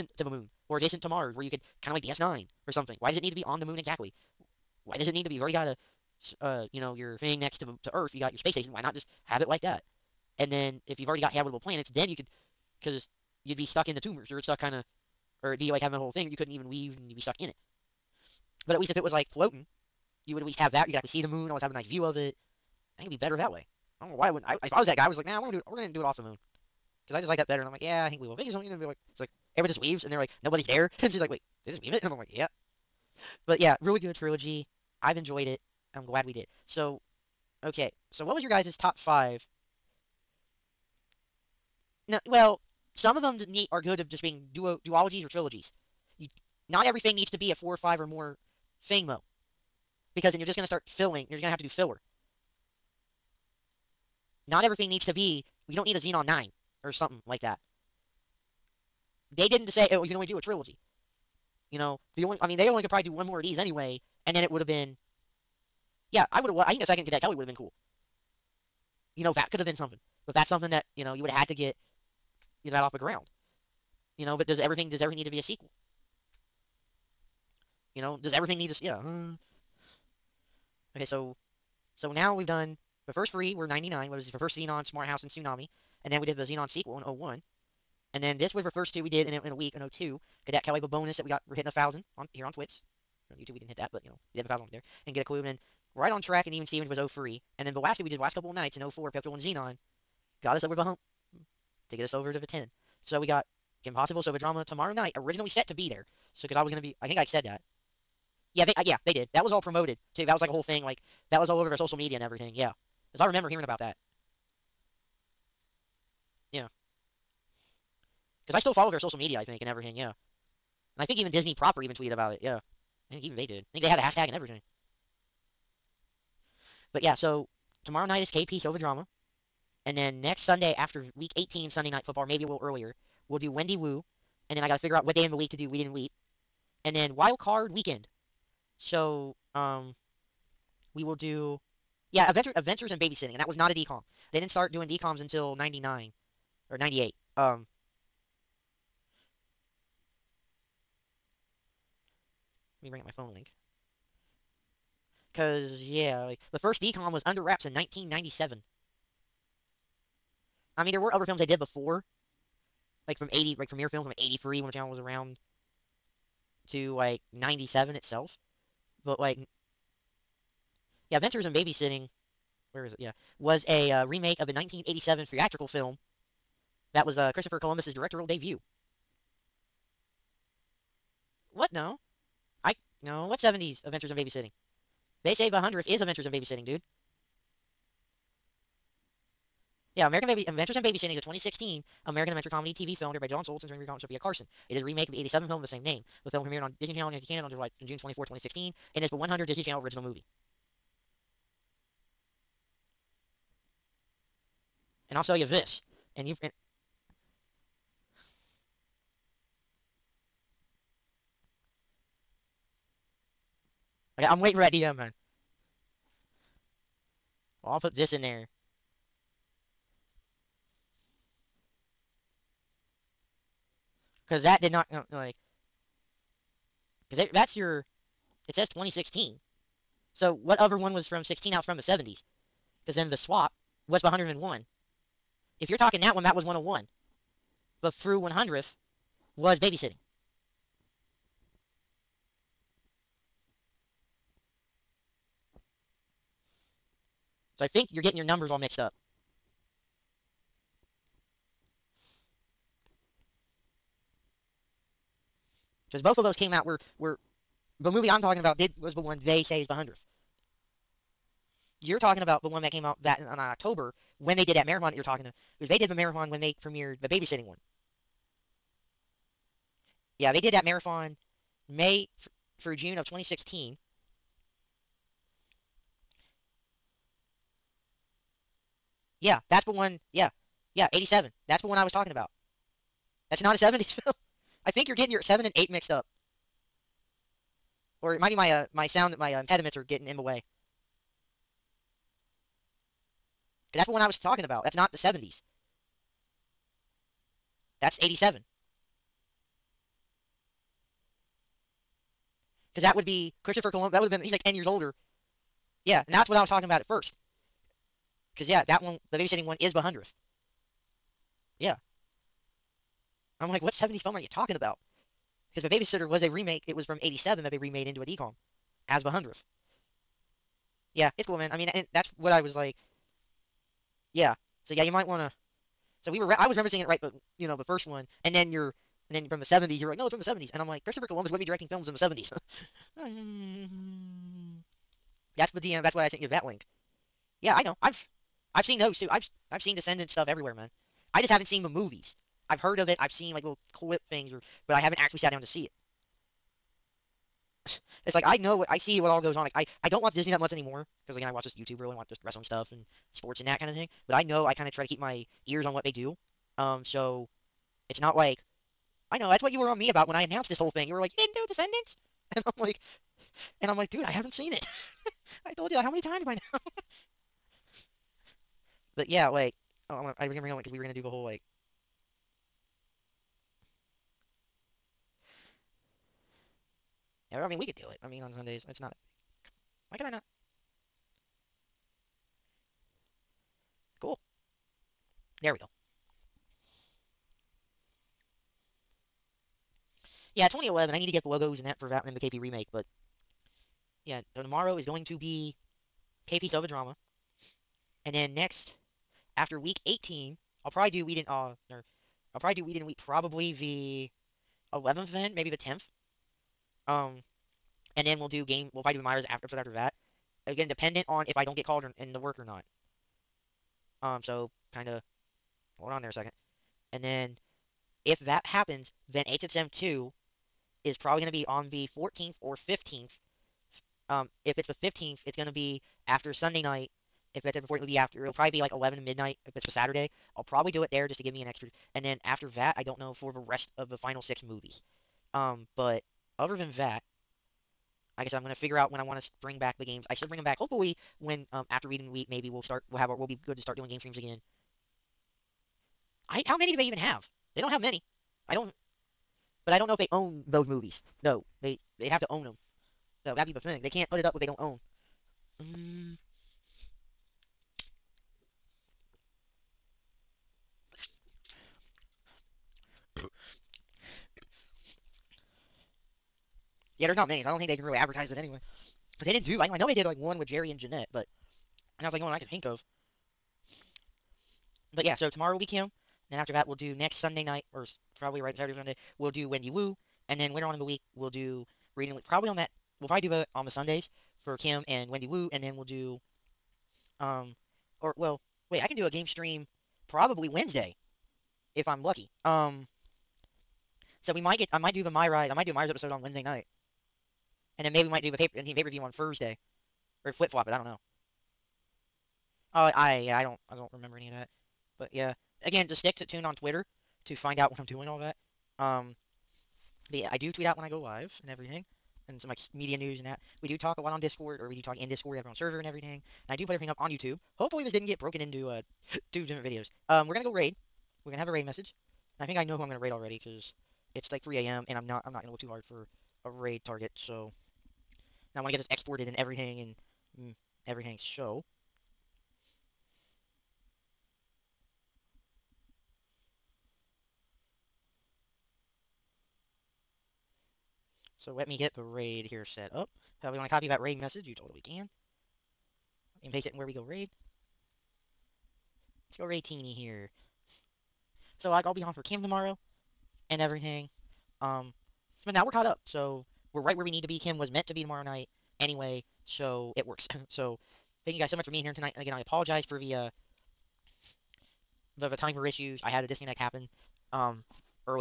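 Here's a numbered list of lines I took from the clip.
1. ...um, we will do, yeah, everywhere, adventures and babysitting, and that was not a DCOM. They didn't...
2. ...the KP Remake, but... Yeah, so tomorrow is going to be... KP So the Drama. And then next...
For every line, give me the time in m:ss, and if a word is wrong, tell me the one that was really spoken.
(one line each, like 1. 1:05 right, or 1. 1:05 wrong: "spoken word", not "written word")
1. 2:19 wrong: "adventure", not "everywhere"
2. 6:32 right.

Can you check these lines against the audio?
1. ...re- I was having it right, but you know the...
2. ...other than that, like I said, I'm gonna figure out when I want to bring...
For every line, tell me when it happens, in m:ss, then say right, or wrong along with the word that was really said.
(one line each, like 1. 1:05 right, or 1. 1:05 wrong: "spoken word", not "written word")
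1. 5:26 wrong: "referencing", not "having"
2. 7:16 right.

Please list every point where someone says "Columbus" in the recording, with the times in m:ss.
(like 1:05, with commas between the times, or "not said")
2:57, 5:03, 5:31.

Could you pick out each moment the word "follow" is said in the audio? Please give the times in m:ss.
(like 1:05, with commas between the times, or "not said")
1:58.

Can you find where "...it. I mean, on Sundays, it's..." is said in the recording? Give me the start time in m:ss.
6:17.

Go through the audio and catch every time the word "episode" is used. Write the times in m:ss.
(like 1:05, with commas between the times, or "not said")
6:49, 8:15.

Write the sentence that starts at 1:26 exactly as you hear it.
And then we did the Zenon sequel in 01.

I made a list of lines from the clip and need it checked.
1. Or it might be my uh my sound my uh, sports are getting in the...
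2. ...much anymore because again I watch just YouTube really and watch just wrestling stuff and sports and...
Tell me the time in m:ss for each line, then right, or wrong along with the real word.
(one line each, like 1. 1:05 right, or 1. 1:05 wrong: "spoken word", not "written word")
1. 4:48 wrong: "impediments", not "sports"
2. 5:50 right.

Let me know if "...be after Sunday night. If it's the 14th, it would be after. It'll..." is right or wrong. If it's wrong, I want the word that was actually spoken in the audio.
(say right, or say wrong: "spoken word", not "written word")
right.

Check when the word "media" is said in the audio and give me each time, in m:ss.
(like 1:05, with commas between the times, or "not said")
1:51, 1:59, 8:32.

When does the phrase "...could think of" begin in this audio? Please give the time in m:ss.
7:52.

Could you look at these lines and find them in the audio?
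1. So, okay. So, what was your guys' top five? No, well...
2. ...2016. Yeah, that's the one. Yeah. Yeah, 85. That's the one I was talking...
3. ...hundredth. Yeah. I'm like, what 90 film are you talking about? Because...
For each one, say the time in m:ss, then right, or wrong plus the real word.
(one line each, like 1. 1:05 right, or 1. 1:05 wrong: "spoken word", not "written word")
1. 0:36 right
2. 4:33 wrong: "87", not "85"
3. 5:09 wrong: "70", not "90".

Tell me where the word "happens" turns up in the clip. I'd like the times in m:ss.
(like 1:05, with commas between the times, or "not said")
6:58, 9:26.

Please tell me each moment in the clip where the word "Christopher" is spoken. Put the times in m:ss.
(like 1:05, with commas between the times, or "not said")
2:57, 5:03, 5:30.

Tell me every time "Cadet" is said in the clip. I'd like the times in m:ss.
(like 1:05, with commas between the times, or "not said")
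1:07, 1:30.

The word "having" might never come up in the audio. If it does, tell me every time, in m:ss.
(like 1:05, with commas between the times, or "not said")
0:15.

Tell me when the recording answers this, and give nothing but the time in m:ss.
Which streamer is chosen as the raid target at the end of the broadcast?
9:09.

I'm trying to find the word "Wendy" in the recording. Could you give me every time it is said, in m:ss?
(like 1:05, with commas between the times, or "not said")
2:13, 7:59, 8:05.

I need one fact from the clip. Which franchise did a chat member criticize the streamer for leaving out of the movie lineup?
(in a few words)
Descendants.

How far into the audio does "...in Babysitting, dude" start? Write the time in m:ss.
3:06.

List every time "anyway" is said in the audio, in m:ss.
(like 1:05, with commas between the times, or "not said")
1:03, 7:48, 9:18.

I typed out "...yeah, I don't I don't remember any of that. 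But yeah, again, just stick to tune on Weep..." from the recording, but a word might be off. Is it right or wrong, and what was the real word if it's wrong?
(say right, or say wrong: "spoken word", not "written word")
wrong: "Twitter", not "Weep".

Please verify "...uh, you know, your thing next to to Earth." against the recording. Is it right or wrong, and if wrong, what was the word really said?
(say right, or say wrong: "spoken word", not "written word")
right.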